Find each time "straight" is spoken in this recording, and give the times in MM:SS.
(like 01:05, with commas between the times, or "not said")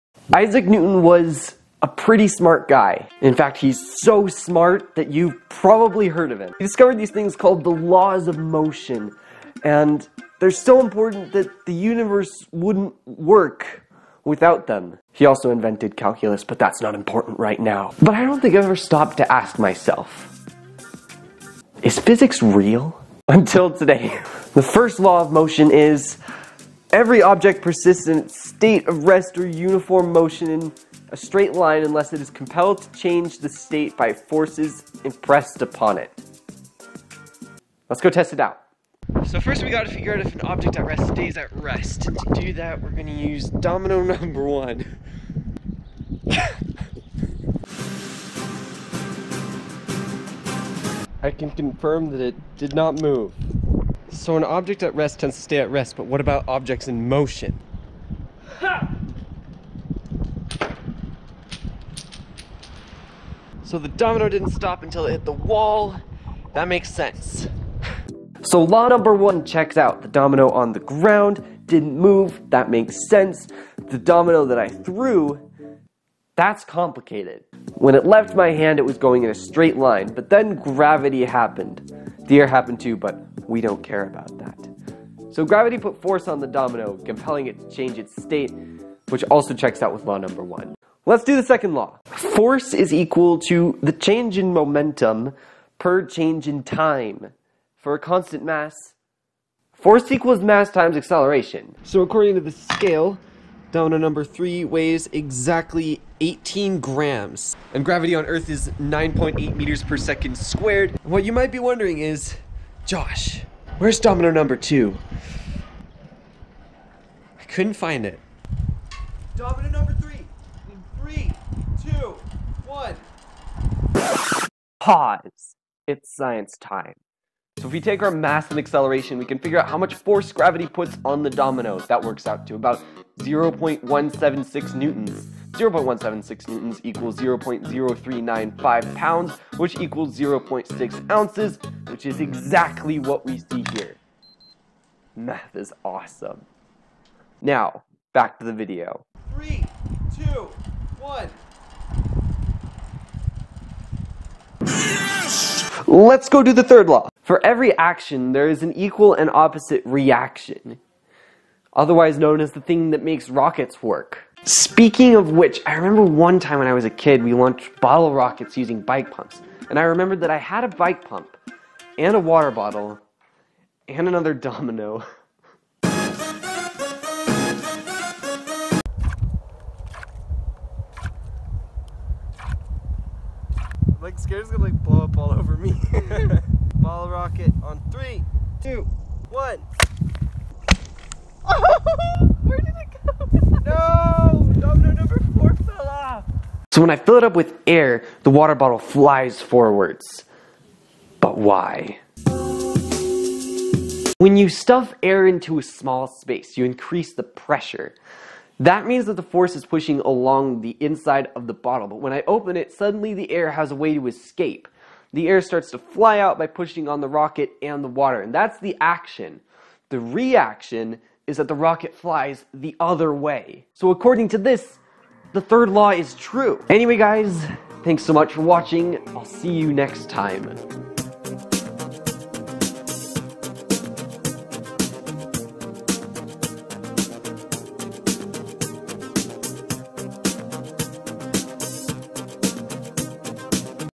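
00:31, 01:19.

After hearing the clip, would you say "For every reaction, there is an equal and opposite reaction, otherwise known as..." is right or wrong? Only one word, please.
wrong.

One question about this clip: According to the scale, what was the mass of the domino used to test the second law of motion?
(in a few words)
18 grams.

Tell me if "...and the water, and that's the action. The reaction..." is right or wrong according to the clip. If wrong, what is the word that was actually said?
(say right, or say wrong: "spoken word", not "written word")
right.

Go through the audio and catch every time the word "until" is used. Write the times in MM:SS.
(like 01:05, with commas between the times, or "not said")
00:23, 01:04.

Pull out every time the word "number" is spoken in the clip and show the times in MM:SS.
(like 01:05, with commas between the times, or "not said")
00:44, 01:08, 01:30, 01:43, 01:54, 01:59.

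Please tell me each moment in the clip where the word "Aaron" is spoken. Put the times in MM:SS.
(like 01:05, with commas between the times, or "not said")
not said.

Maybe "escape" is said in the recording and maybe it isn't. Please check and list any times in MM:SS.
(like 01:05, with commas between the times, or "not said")
03:34.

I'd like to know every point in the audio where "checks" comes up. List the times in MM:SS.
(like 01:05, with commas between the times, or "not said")
01:09, 01:29.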